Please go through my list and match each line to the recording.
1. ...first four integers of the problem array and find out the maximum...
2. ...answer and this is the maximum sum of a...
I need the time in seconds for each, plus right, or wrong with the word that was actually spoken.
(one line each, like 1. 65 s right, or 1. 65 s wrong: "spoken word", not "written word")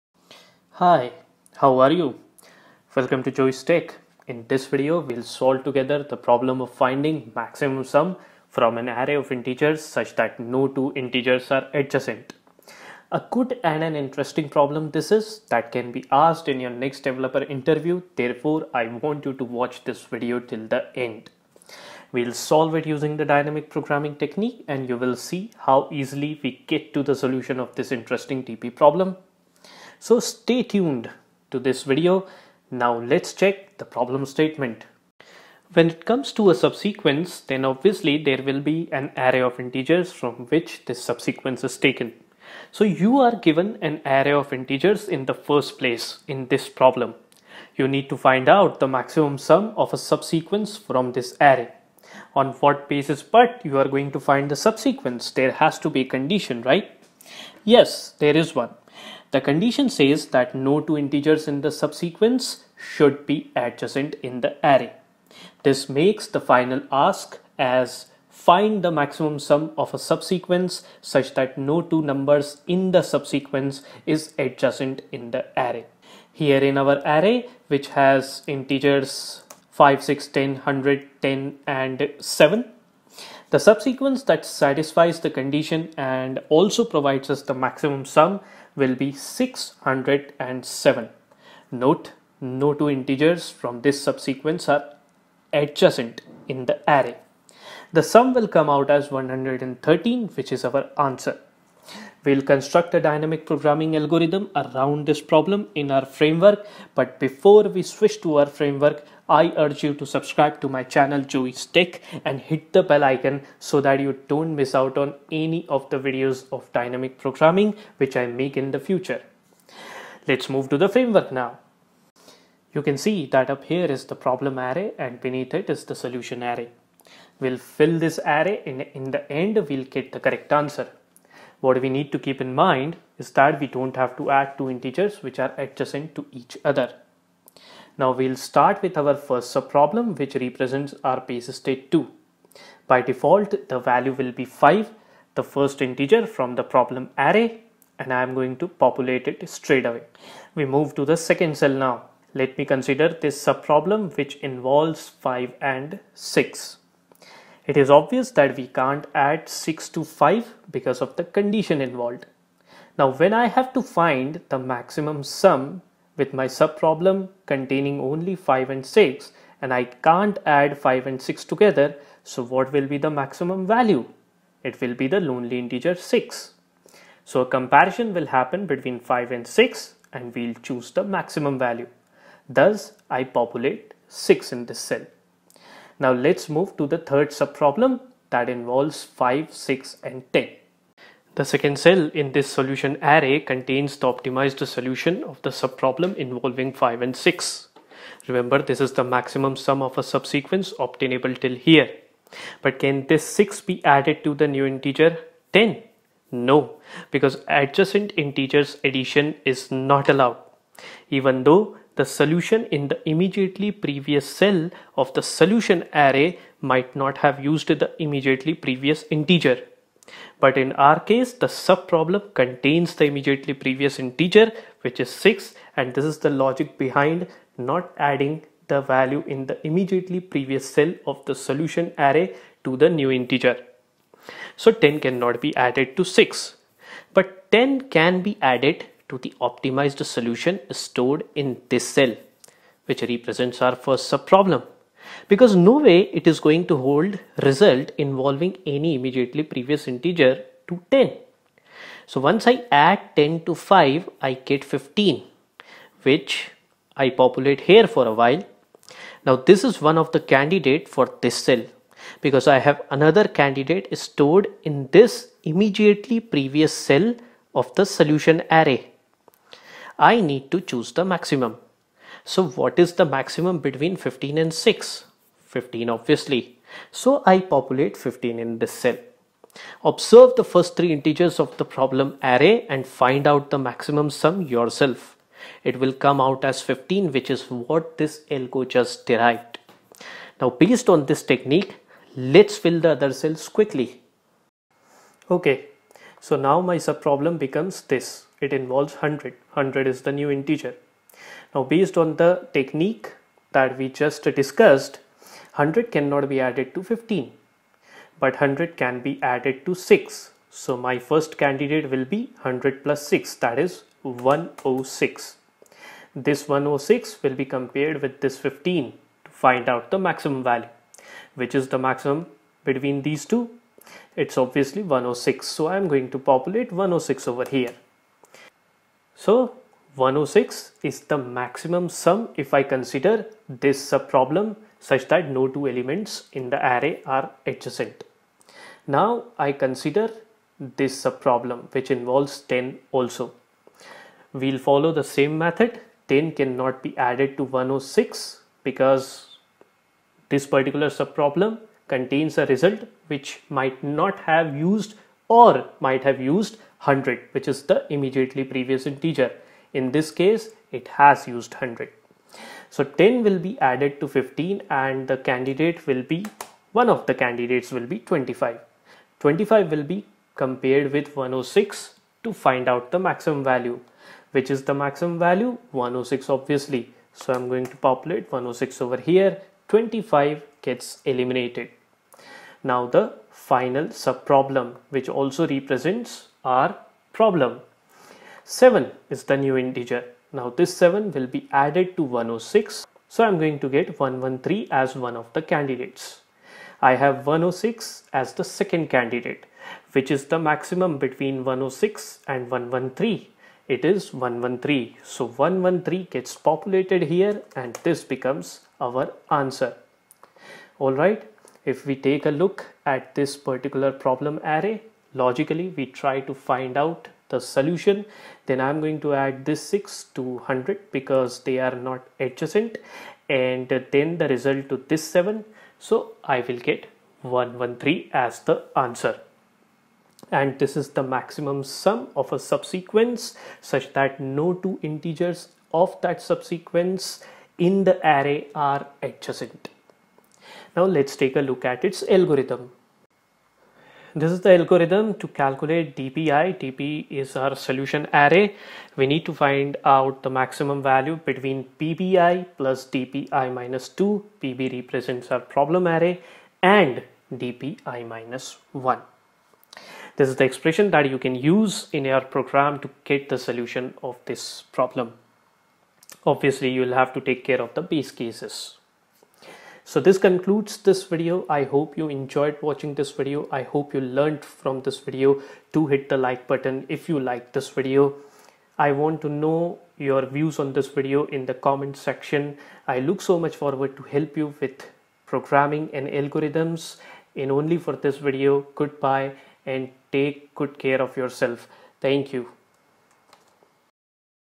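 1. 280 s wrong: "three", not "four"
2. 428 s right.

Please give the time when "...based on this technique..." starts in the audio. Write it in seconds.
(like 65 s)
290 s.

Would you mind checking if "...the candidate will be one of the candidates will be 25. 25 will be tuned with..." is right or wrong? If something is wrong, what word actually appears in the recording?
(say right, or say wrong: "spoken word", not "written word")
wrong: "compared", not "tuned".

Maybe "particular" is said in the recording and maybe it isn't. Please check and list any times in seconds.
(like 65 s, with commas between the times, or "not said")
350 s, 413 s.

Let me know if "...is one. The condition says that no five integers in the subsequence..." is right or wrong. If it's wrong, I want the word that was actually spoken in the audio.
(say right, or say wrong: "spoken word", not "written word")
wrong: "two", not "five".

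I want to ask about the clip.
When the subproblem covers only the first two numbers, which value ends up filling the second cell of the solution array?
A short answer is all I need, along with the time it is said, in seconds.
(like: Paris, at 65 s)
6, at 183 s.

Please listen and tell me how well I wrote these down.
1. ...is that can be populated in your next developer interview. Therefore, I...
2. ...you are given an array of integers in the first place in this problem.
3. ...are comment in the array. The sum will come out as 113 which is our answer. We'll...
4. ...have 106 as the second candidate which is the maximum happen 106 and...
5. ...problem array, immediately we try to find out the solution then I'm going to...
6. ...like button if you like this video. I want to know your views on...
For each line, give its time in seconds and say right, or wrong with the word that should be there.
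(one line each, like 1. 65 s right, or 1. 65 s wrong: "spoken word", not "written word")
1. 15 s wrong: "asked", not "populated"
2. 42 s right
3. 94 s wrong: "adjacent", not "comment"
4. 396 s wrong: "between", not "happen"
5. 413 s wrong: "logically", not "immediately"
6. 476 s right.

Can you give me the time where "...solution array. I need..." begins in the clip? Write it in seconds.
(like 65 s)
267 s.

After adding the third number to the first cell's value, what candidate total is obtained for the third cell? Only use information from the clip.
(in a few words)
15.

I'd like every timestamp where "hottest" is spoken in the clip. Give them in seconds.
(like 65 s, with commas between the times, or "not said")
not said.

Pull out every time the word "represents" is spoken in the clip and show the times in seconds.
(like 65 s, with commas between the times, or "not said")
140 s, 243 s, 385 s, 454 s.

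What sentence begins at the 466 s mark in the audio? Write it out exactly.
Obviously, you will have to take care of the base cases.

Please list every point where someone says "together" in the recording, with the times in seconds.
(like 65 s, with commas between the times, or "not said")
5 s, 171 s.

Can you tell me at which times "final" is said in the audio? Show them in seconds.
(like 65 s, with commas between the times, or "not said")
66 s, 383 s.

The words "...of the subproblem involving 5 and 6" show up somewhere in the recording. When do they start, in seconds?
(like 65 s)
195 s.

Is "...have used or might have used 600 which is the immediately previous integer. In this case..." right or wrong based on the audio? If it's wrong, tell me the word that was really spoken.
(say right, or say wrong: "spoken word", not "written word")
wrong: "100", not "600".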